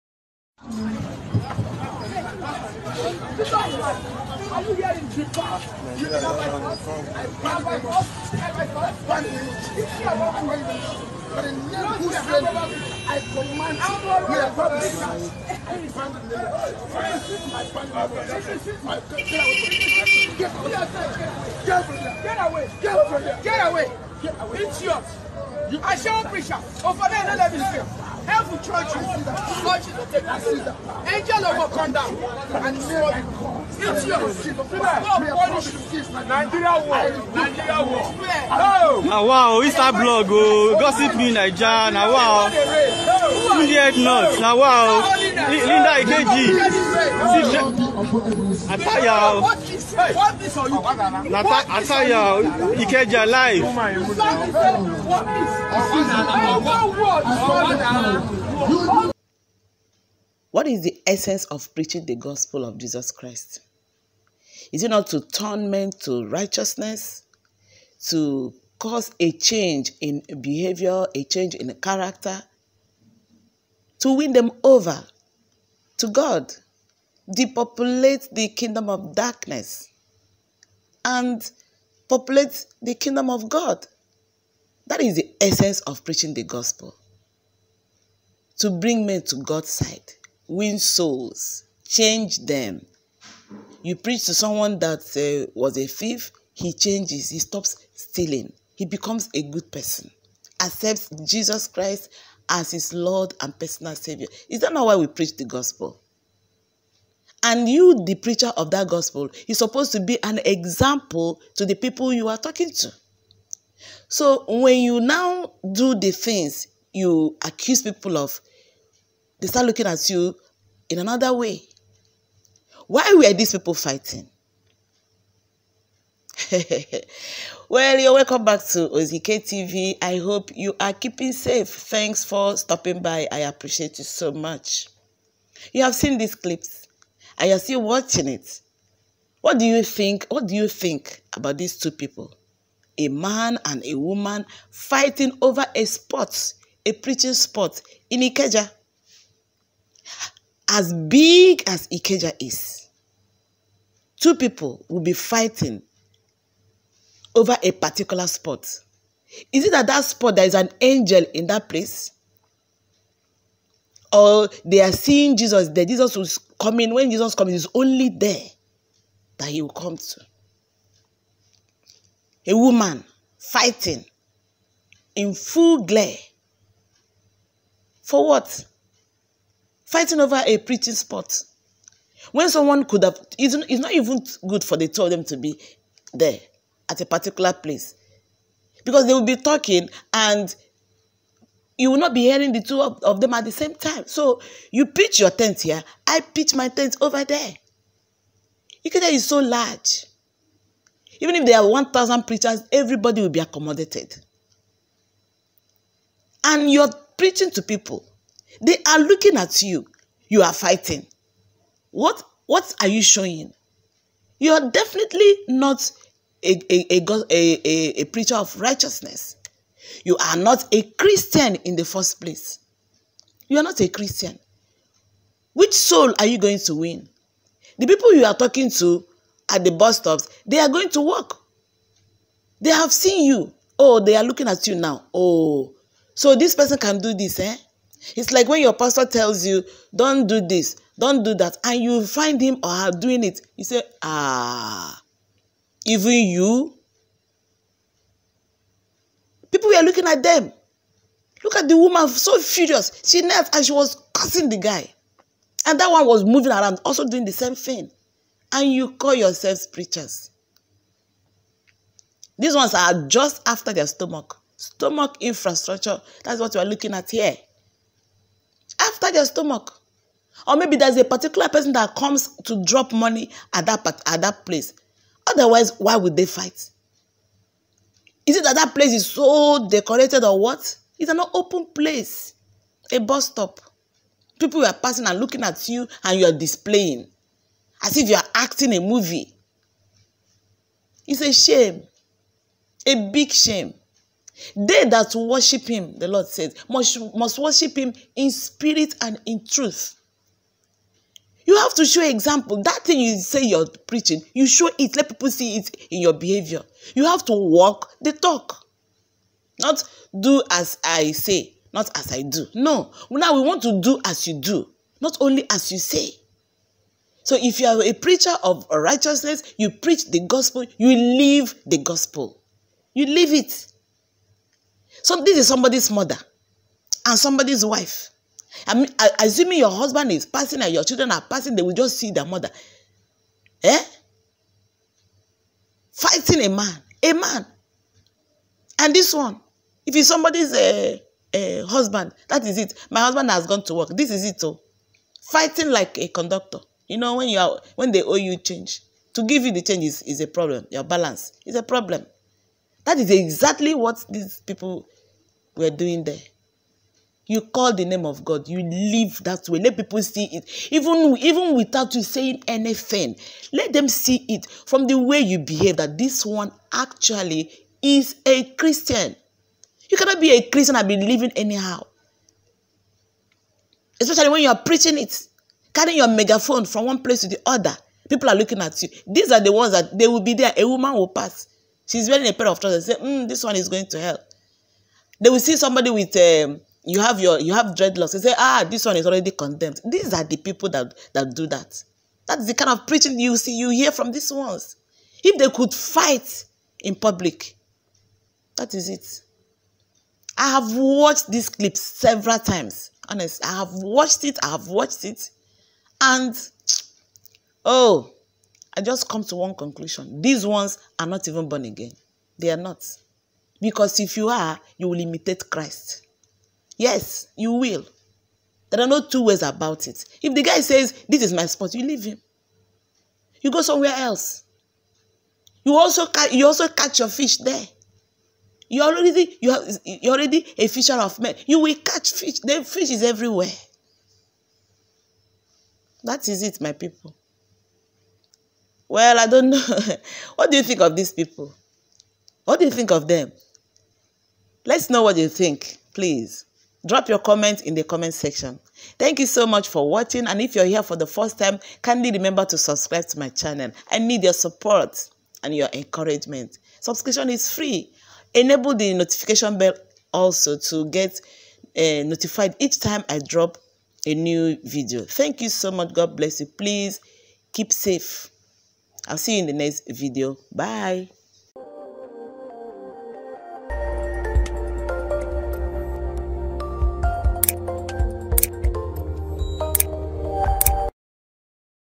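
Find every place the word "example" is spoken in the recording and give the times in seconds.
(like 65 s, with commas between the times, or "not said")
110 s, 302 s.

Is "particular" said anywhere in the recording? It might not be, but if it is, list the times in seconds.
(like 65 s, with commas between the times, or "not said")
157 s, 187 s, 271 s.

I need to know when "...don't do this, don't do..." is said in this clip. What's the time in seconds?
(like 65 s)
239 s.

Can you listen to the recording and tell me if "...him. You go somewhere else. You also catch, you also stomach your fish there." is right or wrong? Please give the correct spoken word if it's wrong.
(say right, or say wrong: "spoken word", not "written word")
wrong: "catch", not "stomach".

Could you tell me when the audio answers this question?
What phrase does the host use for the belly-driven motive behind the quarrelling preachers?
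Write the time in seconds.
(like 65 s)
264 s.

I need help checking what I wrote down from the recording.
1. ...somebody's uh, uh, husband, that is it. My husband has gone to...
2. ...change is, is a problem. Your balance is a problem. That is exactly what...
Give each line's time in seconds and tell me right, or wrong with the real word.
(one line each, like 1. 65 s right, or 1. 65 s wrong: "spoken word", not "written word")
1. 340 s right
2. 349 s right.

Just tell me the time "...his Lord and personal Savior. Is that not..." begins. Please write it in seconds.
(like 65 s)
102 s.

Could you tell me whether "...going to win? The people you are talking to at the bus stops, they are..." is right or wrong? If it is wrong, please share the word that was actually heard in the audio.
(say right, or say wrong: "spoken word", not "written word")
right.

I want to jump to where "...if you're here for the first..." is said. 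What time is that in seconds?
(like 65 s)
450 s.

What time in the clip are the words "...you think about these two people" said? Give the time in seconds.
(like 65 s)
140 s.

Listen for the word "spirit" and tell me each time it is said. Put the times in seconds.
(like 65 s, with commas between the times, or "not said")
298 s.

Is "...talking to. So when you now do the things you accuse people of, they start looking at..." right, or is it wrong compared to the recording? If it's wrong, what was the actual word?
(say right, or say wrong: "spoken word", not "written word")
right.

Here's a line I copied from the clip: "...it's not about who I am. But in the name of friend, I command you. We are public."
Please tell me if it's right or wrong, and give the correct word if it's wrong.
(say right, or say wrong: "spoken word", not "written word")
right.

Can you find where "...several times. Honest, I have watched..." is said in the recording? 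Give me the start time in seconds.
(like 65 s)
401 s.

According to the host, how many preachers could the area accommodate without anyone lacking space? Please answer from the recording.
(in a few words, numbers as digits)
1,000.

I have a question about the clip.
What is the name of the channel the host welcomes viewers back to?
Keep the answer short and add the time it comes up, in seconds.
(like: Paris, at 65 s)
Ozike TV, at 128 s.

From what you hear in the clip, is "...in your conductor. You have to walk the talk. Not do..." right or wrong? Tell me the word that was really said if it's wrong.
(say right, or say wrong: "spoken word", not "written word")
wrong: "behavior", not "conductor".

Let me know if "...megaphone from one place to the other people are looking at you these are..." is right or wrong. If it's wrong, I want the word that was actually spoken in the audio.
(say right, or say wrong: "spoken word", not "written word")
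right.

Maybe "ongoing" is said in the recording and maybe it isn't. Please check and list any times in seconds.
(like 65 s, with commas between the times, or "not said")
not said.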